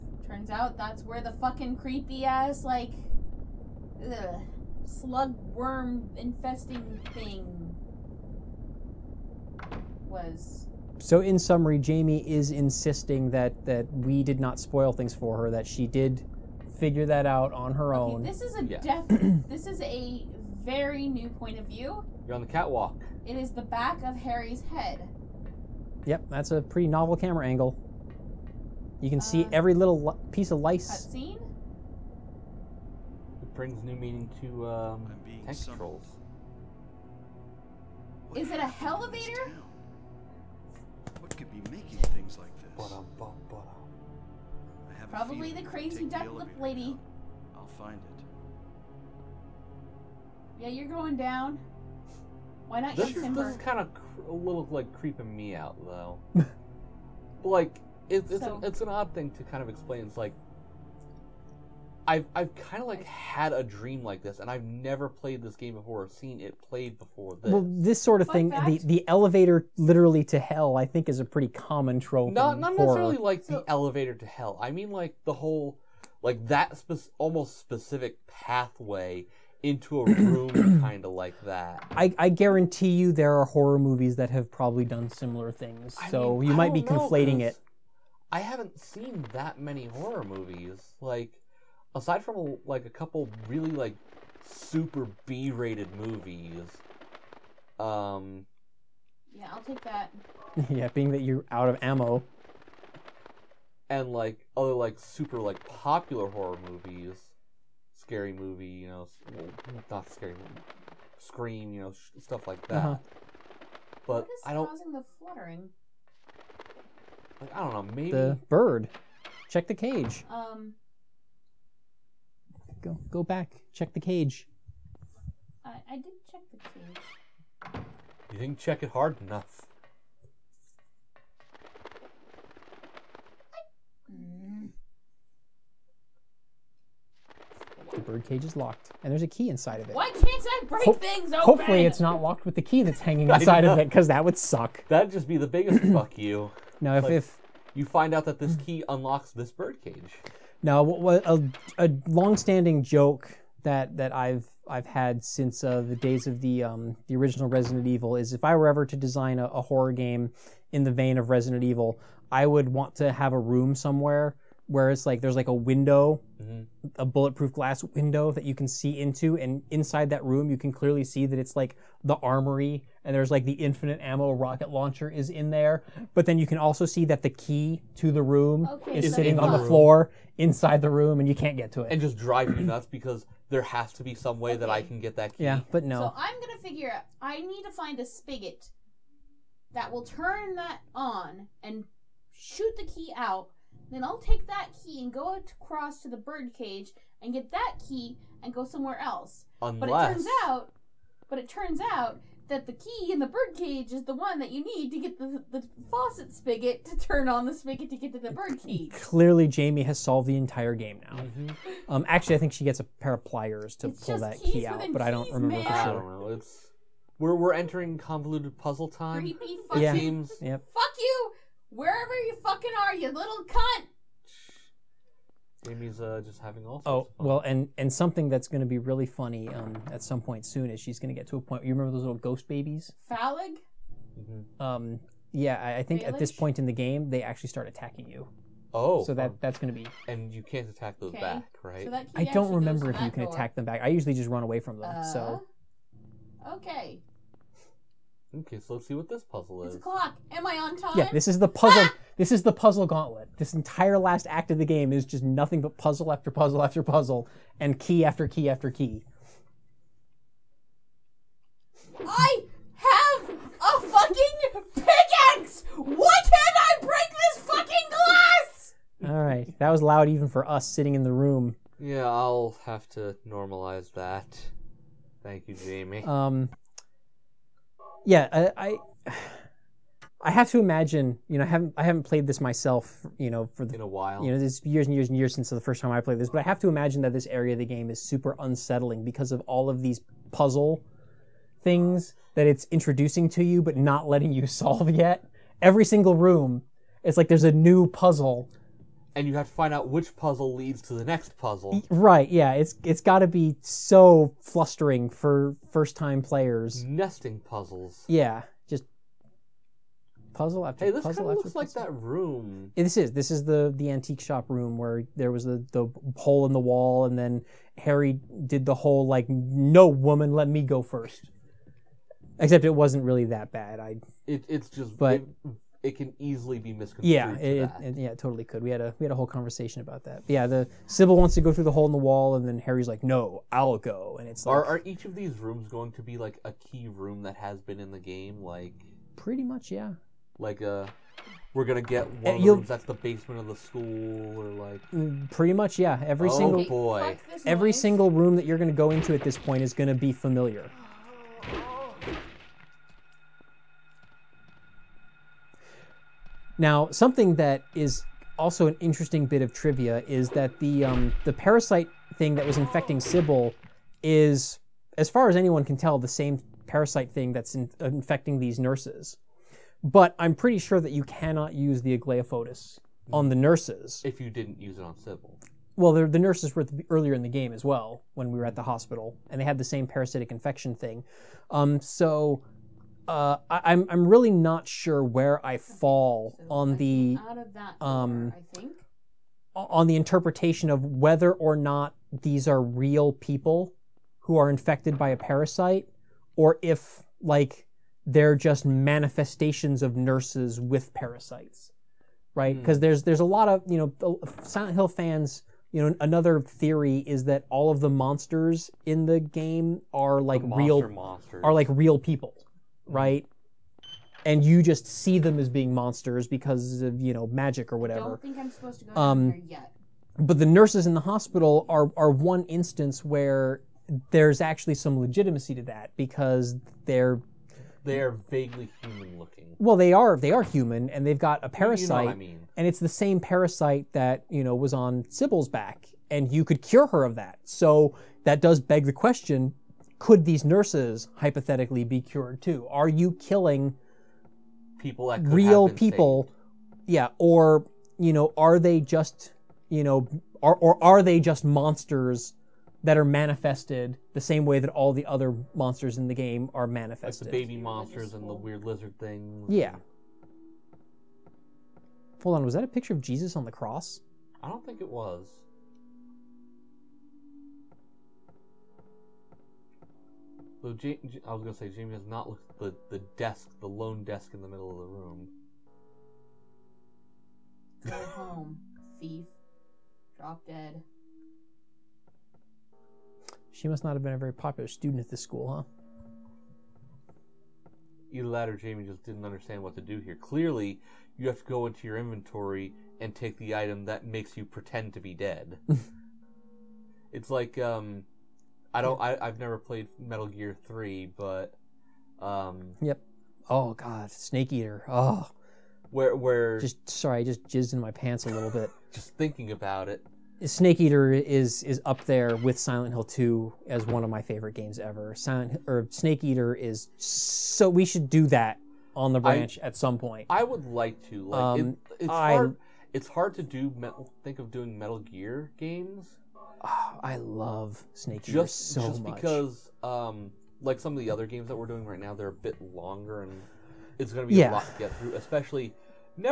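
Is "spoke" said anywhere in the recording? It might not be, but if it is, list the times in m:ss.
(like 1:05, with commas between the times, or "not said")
not said.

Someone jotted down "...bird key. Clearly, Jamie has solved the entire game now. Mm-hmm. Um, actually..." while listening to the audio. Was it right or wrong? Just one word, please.
right.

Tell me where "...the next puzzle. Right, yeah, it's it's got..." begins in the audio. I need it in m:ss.
5:00.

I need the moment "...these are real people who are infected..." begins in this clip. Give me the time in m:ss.
6:32.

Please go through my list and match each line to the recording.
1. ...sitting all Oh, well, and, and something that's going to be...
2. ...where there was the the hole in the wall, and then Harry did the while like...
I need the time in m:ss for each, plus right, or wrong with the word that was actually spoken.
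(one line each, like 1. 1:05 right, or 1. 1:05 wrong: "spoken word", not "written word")
1. 3:46 wrong: "having", not "sitting"
2. 5:14 wrong: "whole", not "while".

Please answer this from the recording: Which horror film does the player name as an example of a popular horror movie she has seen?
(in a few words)
Scream.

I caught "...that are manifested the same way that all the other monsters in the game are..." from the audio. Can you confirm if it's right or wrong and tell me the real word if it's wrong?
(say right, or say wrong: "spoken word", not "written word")
right.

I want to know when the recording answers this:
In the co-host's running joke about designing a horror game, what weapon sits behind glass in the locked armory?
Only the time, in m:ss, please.
2:53.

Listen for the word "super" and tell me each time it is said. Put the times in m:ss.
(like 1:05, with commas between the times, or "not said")
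1:34, 1:44, 4:48.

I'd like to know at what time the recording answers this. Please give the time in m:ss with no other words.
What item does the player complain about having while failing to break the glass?
4:24.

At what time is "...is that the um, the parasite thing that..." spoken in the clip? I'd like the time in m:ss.
6:00.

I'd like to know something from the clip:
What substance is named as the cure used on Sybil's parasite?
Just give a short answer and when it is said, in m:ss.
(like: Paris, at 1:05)
Aglaophotis, at 6:11.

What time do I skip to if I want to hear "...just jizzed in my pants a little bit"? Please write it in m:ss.
8:27.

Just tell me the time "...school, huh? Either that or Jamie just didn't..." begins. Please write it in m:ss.
8:05.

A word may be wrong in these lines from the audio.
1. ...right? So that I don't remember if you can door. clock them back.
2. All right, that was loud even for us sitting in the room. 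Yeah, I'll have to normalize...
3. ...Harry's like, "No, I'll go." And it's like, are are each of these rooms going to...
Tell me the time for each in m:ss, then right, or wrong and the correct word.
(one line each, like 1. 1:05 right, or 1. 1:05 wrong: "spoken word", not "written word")
1. 4:01 wrong: "attack", not "clock"
2. 4:29 right
3. 5:32 right.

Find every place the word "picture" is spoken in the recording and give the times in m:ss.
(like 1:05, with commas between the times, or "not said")
7:42.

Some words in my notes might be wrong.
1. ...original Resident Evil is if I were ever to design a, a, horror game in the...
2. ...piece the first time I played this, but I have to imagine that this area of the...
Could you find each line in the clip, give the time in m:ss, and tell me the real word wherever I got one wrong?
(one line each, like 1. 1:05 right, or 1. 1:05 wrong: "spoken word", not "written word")
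1. 2:37 right
2. 4:45 wrong: "since", not "piece".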